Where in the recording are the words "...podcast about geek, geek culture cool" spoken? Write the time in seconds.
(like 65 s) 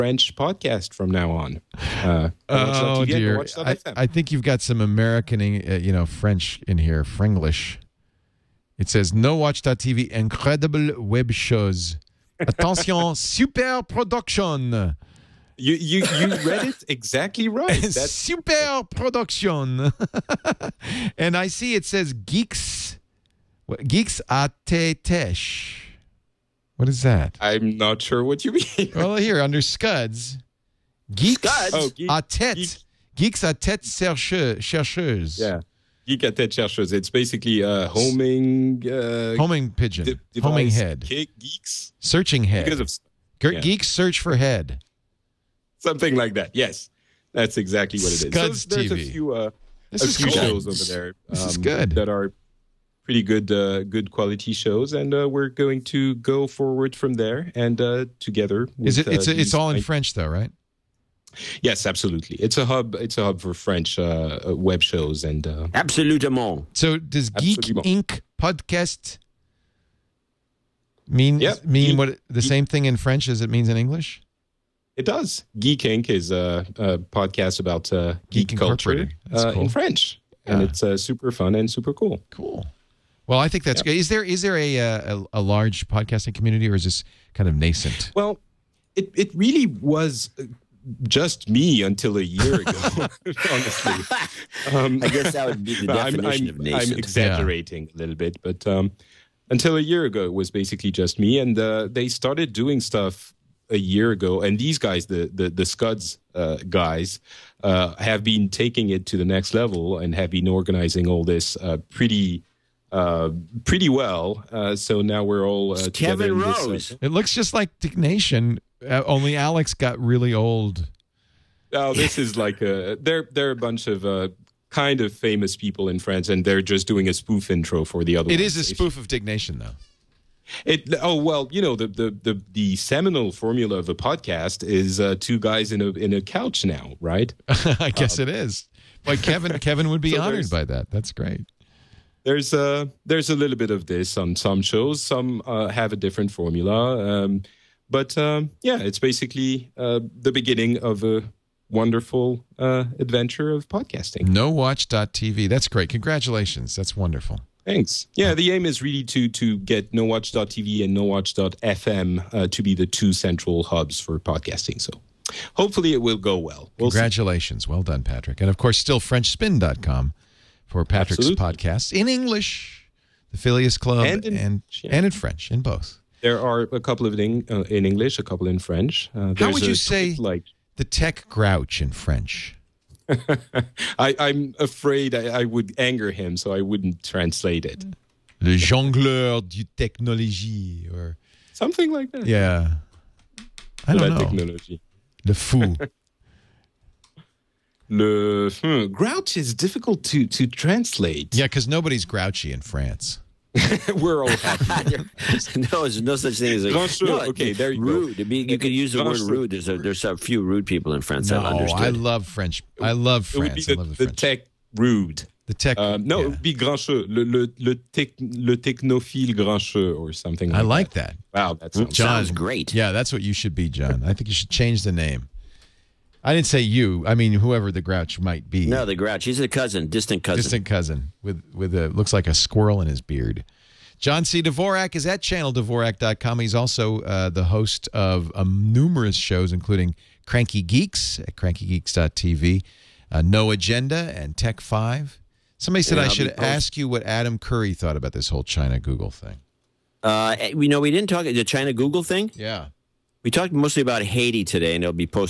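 76 s.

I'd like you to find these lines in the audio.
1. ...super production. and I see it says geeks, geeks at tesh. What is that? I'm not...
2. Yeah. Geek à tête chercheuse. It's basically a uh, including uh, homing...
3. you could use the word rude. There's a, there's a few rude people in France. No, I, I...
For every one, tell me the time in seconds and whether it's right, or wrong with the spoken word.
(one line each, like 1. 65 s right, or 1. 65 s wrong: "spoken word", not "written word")
1. 18 s right
2. 35 s wrong: "homing", not "including"
3. 208 s right.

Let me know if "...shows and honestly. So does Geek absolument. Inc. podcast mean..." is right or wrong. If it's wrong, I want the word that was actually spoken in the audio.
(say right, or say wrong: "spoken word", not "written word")
wrong: "absolutely", not "honestly".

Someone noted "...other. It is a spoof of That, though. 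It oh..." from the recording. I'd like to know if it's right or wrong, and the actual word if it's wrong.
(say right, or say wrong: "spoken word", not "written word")
wrong: "Diggnation", not "That".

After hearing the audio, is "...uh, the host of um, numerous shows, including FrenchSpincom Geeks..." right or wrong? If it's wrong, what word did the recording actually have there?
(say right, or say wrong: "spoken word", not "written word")
wrong: "Cranky", not "FrenchSpincom".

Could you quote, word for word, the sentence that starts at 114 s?
Uh, so now we're all uh, Kevin Rose.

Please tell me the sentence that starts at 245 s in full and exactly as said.
Somebody said yeah, I should ask you what Adam Curry thought about this whole China Google thing.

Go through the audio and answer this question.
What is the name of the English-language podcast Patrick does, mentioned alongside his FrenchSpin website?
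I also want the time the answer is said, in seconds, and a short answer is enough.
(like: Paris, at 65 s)
Phileas Club, at 173 s.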